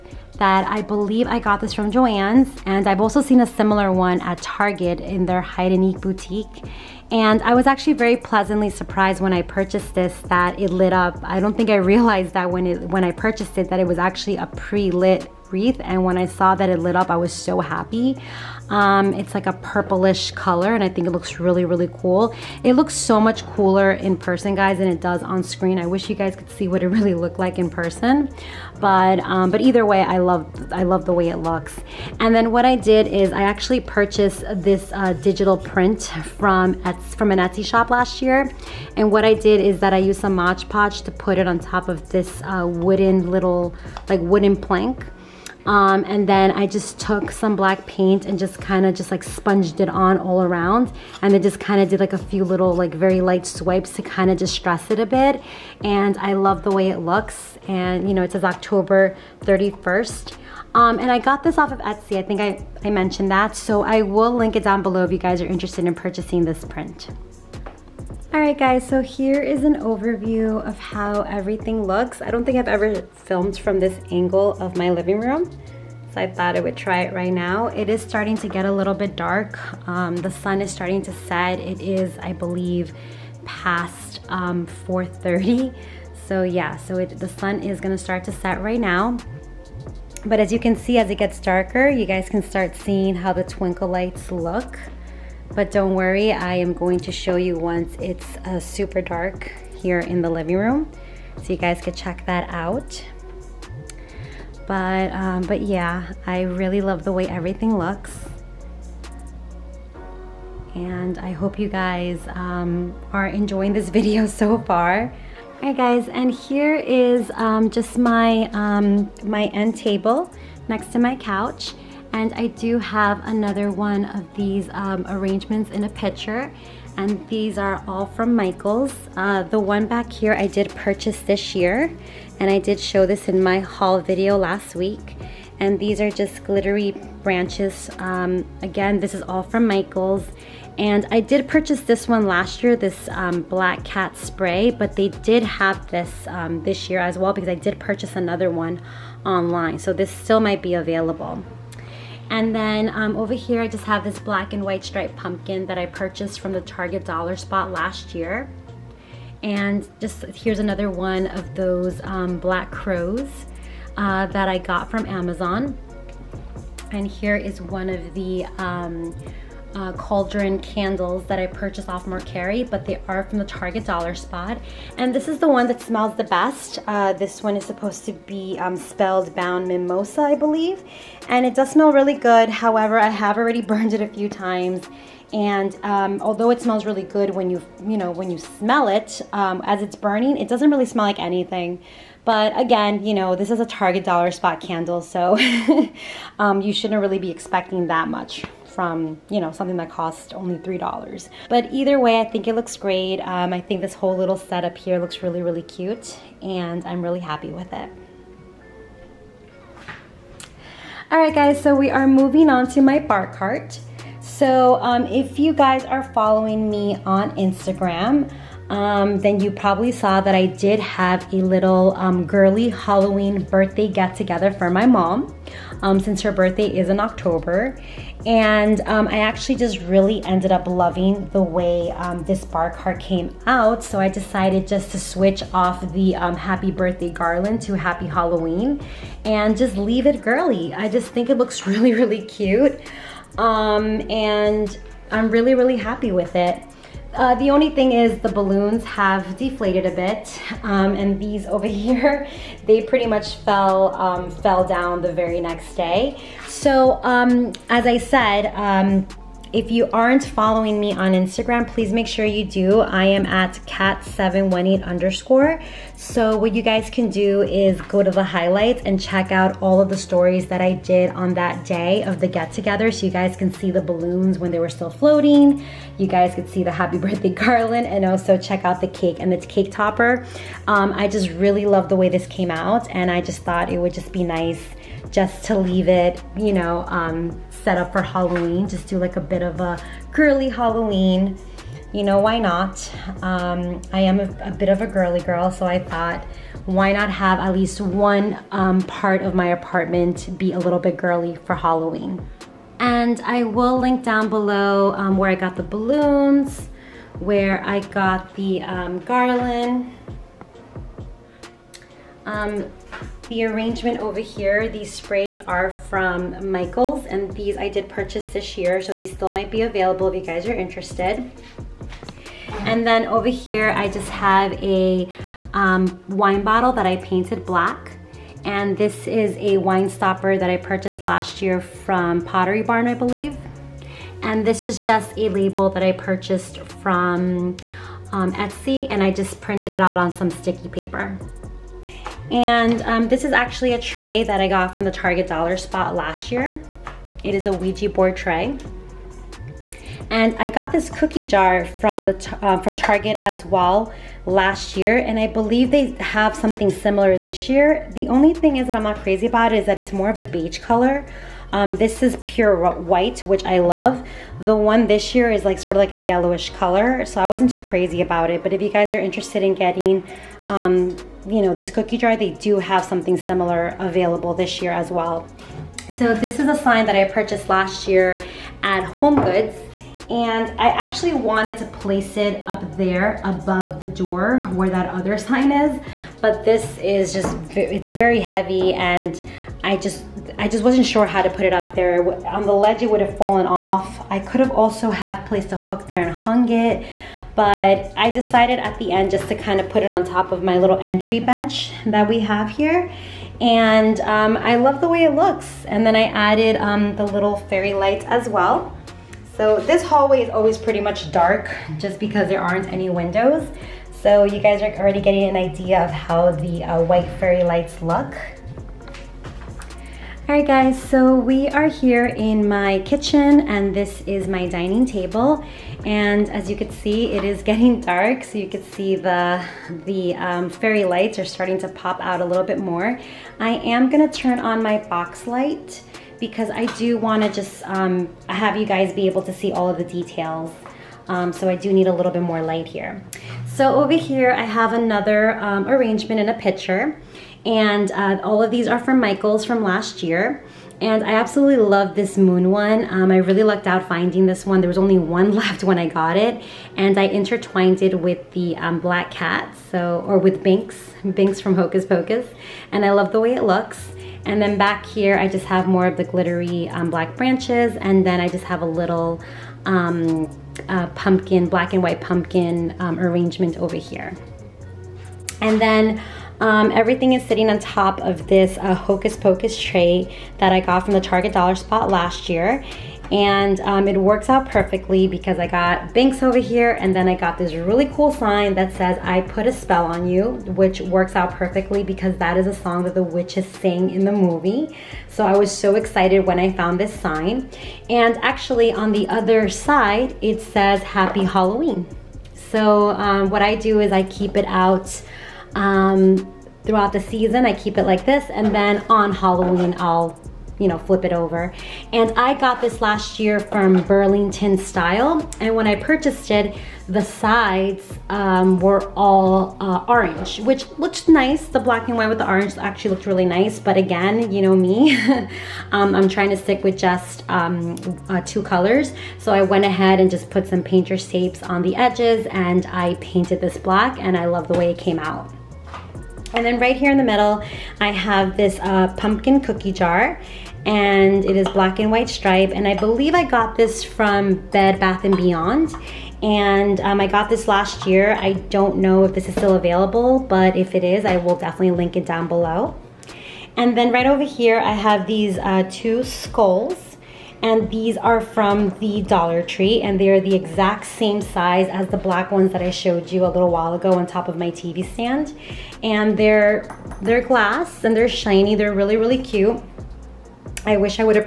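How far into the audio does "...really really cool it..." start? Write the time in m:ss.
0:21.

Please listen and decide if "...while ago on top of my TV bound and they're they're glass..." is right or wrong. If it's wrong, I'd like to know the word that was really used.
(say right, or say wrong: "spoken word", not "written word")
wrong: "stand", not "bound".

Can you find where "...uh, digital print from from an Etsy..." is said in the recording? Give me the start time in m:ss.
0:34.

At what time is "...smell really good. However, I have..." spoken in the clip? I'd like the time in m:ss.
3:01.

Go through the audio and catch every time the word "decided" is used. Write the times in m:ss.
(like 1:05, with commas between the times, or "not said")
3:54, 6:38.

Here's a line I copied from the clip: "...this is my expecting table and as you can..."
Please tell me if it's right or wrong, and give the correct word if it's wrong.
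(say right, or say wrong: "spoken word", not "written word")
wrong: "dining", not "expecting".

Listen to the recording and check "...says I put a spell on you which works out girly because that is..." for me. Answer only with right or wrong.
wrong.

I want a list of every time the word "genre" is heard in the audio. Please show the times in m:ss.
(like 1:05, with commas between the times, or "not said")
not said.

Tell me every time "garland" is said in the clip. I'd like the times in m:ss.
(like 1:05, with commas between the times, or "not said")
3:57, 4:37, 5:09.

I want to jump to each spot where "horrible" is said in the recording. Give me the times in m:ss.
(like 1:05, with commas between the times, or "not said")
not said.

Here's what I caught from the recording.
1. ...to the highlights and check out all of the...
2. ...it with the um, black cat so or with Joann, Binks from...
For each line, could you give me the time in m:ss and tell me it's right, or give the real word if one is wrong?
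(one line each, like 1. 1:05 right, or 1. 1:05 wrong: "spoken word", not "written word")
1. 4:28 right
2. 7:37 wrong: "Binks", not "Joann".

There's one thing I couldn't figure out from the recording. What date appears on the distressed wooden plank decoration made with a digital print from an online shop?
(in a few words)
October 31st.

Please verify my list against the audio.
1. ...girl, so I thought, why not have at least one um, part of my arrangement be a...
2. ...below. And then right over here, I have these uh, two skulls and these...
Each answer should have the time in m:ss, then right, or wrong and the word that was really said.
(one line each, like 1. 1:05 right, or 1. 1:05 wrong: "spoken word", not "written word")
1. 4:55 wrong: "apartment", not "arrangement"
2. 9:12 right.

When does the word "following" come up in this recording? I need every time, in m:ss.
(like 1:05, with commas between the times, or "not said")
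3:36, 4:20.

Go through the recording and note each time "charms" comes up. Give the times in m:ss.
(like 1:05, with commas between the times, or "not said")
not said.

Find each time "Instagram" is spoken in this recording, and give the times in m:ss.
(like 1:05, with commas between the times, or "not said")
3:37, 4:21.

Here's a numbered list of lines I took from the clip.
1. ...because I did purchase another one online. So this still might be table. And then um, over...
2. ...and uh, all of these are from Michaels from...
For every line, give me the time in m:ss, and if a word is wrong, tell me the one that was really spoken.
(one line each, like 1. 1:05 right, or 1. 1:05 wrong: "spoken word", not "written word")
1. 2:27 wrong: "available", not "table"
2. 7:27 right.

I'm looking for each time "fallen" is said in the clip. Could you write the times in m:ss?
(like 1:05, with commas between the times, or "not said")
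6:33.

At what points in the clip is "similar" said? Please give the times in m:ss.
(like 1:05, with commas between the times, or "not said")
0:03, 5:56, 6:13.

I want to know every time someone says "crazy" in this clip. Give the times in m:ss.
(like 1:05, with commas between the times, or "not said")
5:58, 6:07.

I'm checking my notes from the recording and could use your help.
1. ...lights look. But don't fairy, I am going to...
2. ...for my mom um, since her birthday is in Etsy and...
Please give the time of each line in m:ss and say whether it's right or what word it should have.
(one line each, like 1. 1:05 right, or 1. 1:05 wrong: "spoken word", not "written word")
1. 1:33 wrong: "worry", not "fairy"
2. 3:44 wrong: "October", not "Etsy".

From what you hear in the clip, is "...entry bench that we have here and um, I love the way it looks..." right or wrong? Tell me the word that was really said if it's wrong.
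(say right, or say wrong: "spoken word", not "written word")
right.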